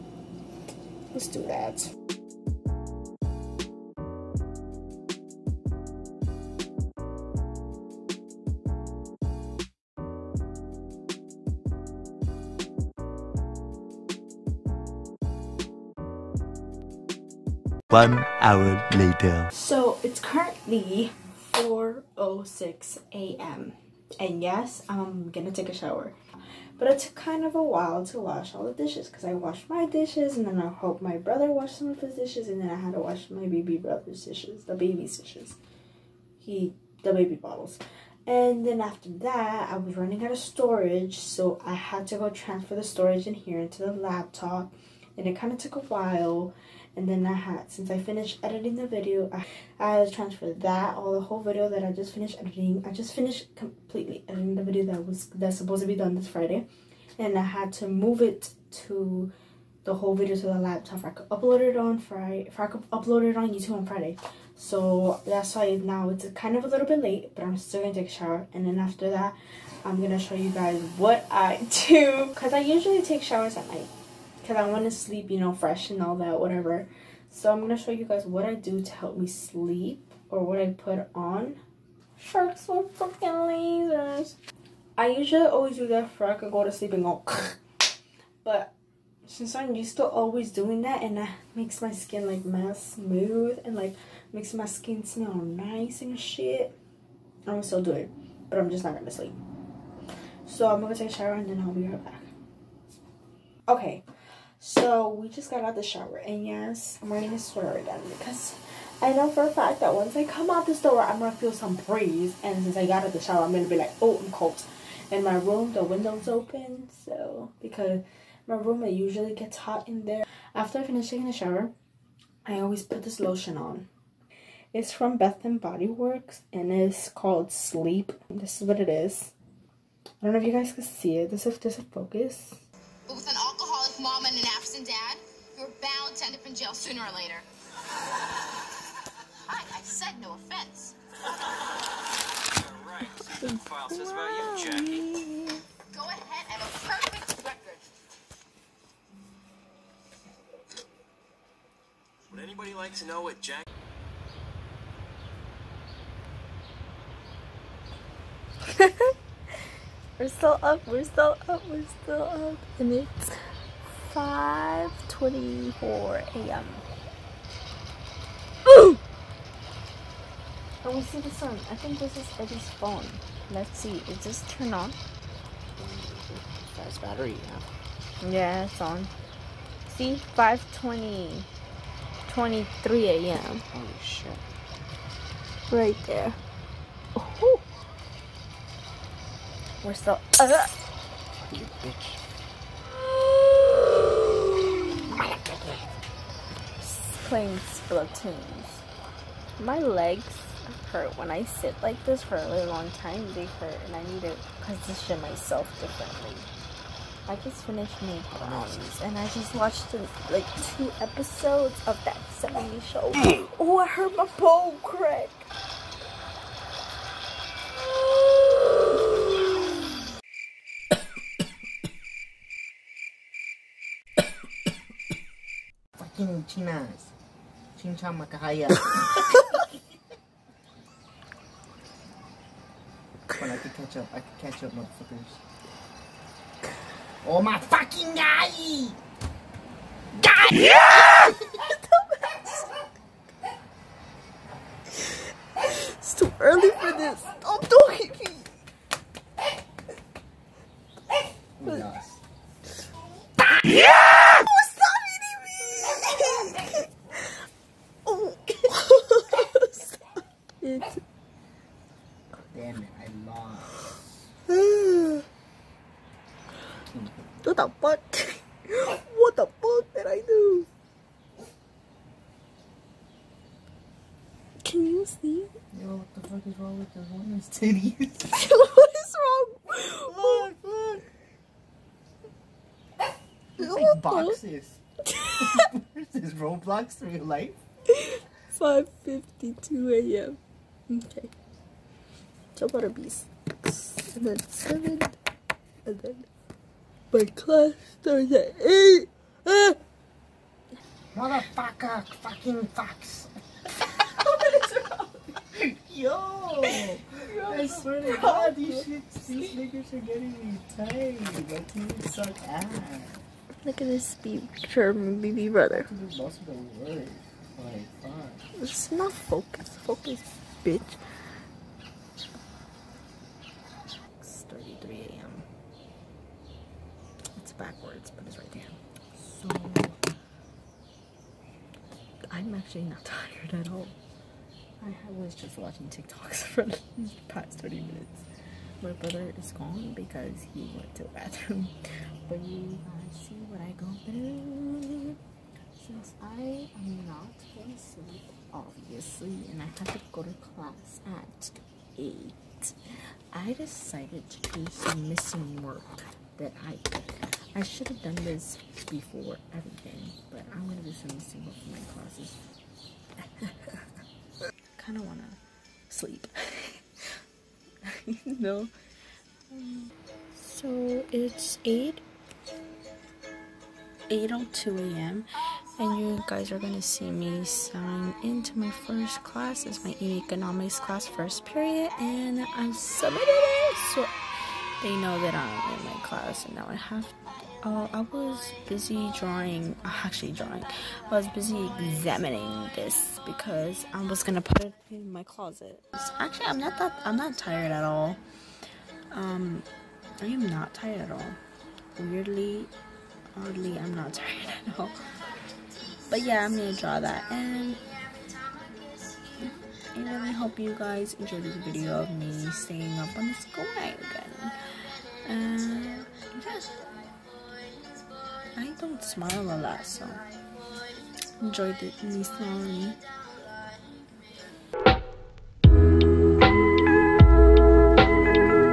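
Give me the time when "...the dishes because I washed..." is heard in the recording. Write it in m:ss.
0:28.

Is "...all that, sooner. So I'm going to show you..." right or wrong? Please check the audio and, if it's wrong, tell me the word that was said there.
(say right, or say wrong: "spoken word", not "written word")
wrong: "whatever", not "sooner".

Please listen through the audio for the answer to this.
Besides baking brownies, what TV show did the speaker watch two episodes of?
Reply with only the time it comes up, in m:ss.
3:32.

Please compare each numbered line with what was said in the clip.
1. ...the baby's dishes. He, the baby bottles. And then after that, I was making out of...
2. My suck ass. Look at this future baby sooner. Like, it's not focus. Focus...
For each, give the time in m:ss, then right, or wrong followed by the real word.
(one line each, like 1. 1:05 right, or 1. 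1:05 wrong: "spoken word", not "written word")
1. 0:34 wrong: "running", not "making"
2. 5:12 wrong: "brother", not "sooner".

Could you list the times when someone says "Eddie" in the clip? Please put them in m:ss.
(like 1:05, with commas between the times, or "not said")
2:52.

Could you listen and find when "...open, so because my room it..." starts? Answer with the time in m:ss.
1:56.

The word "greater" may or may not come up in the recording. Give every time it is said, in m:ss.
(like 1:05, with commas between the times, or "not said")
not said.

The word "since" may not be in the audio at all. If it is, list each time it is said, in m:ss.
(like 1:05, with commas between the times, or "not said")
0:47, 1:29, 1:52, 5:45.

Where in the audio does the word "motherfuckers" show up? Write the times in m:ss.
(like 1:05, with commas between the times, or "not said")
3:54, 5:01.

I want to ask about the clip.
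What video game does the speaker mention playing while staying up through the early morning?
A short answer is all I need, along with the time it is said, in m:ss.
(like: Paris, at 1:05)
Splatoon, at 3:17.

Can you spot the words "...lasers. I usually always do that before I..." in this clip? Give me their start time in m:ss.
1:23.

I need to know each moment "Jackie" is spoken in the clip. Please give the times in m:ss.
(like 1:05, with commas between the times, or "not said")
2:24, 2:33.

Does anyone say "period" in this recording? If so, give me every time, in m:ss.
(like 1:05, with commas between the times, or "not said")
6:21.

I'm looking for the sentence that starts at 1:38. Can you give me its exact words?
But I'm just not gonna sleep.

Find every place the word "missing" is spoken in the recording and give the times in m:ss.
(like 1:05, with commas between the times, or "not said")
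5:55, 6:01.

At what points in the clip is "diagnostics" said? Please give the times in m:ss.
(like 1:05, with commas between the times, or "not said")
not said.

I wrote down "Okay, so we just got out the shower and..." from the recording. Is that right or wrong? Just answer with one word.
right.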